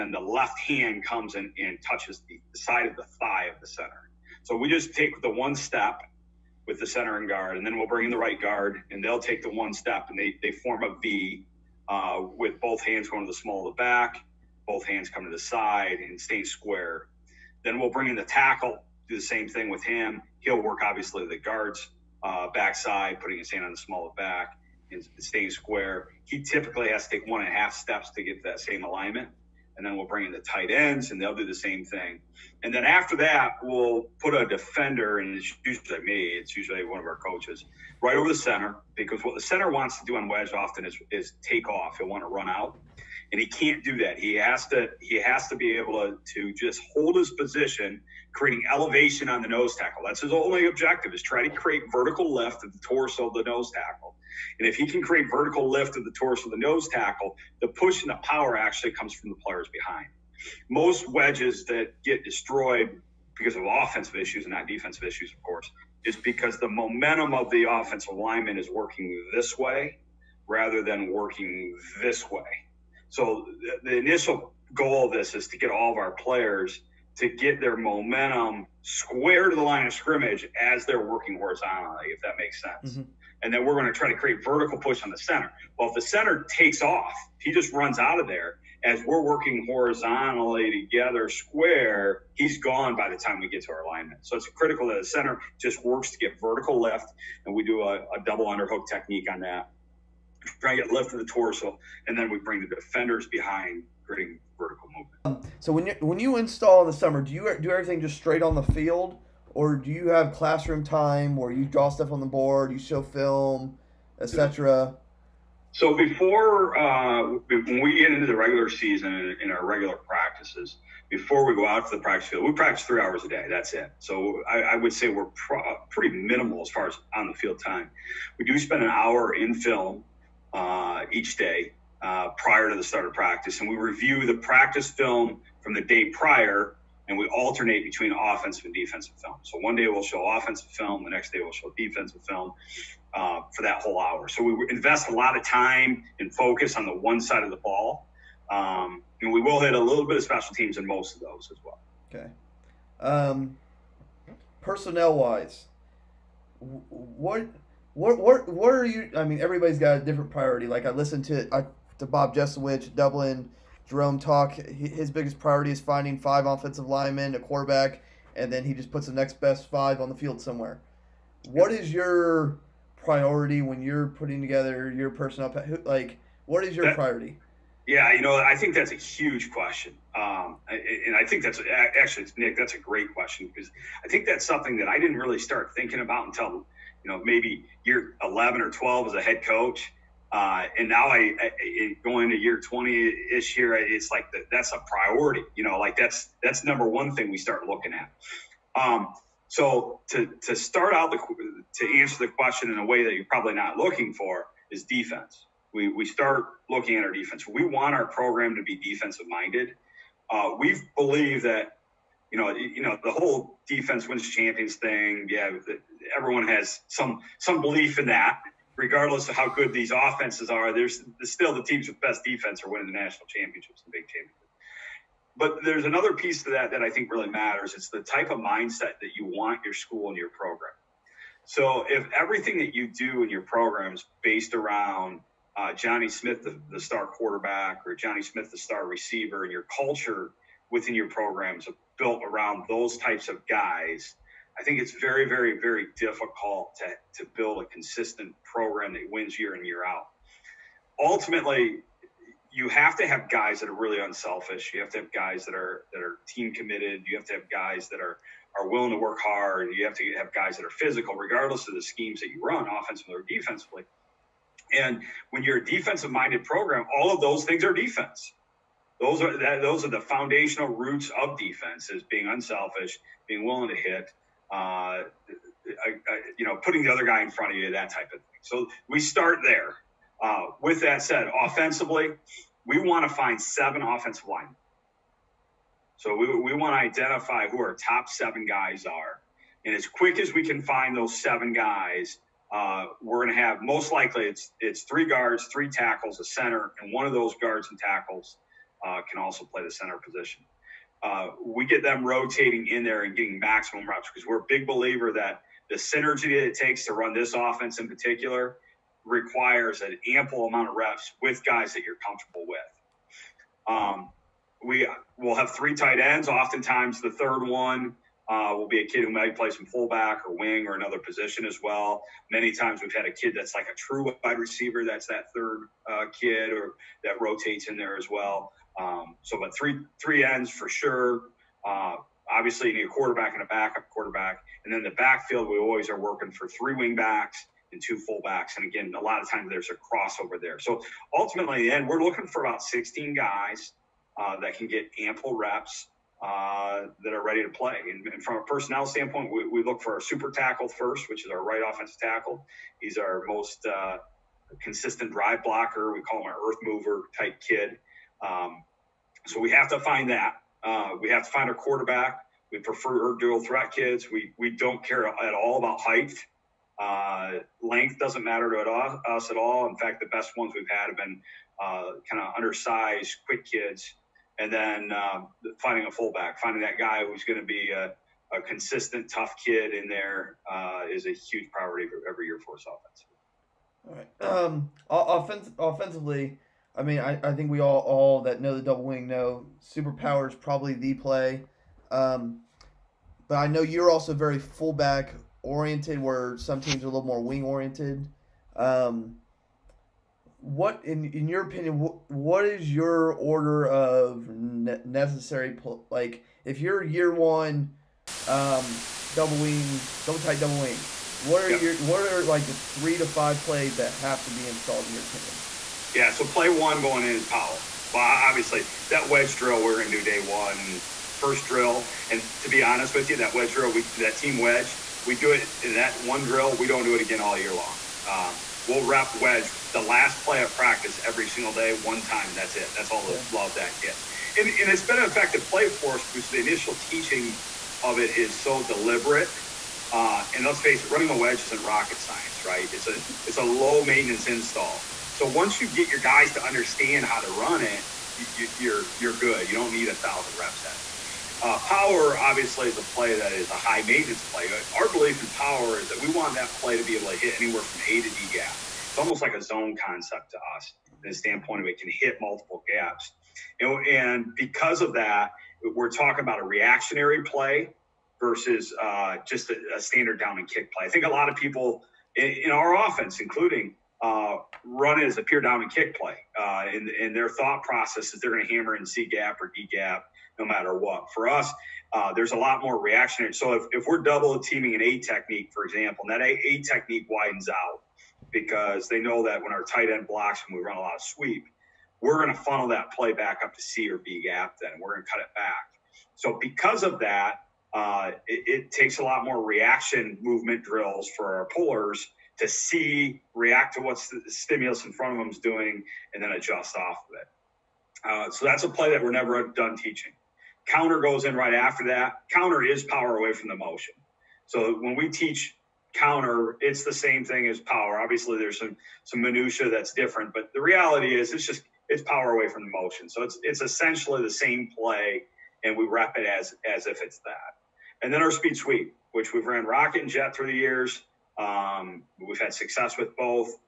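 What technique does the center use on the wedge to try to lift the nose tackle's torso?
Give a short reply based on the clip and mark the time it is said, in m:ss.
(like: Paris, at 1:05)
double underhook, at 1:38.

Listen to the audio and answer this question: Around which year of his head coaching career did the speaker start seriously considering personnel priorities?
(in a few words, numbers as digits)
11 or 12.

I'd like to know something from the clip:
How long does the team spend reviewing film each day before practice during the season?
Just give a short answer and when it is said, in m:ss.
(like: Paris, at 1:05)
an hour, at 2:08.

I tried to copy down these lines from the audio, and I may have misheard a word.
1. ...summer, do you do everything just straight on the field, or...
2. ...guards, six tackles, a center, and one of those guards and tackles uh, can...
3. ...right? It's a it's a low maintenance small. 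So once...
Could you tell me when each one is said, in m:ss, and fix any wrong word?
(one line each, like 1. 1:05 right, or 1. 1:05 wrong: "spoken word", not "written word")
1. 1:46 right
2. 4:55 wrong: "three", not "six"
3. 7:22 wrong: "install", not "small".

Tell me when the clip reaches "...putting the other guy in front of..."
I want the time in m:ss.
4:36.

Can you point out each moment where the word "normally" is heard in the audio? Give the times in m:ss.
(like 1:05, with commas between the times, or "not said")
not said.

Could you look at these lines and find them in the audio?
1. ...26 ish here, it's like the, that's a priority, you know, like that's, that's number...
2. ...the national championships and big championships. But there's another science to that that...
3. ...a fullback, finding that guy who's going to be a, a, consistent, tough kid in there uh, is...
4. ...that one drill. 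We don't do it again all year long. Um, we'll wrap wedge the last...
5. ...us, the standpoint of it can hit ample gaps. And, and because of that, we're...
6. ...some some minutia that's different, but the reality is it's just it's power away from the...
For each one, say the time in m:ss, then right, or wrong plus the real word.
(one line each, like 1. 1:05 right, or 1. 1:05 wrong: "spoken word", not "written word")
1. 3:12 wrong: "20", not "26"
2. 3:42 wrong: "piece", not "science"
3. 6:15 right
4. 7:05 right
5. 7:40 wrong: "multiple", not "ample"
6. 8:38 right.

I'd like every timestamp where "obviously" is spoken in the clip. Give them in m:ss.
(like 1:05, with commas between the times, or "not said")
0:20, 5:32, 6:58, 7:32, 8:37.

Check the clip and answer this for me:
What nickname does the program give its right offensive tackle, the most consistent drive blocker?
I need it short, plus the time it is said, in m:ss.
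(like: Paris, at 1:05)
super tackle, at 5:50.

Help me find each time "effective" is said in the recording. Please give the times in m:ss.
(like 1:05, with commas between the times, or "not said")
7:15.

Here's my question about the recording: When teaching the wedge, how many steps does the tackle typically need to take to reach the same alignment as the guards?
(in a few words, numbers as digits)
1.5.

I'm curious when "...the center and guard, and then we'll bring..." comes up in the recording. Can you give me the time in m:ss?
0:06.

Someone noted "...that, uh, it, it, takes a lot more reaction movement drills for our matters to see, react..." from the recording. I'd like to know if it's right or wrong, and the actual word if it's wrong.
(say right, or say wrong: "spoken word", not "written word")
wrong: "pullers", not "matters".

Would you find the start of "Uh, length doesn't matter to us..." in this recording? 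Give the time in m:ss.
6:06.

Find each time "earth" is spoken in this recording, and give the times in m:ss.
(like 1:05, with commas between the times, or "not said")
5:56.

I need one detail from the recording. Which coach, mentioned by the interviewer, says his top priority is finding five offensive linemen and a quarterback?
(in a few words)
Bob Jesowich.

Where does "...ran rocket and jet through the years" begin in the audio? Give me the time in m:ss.
8:49.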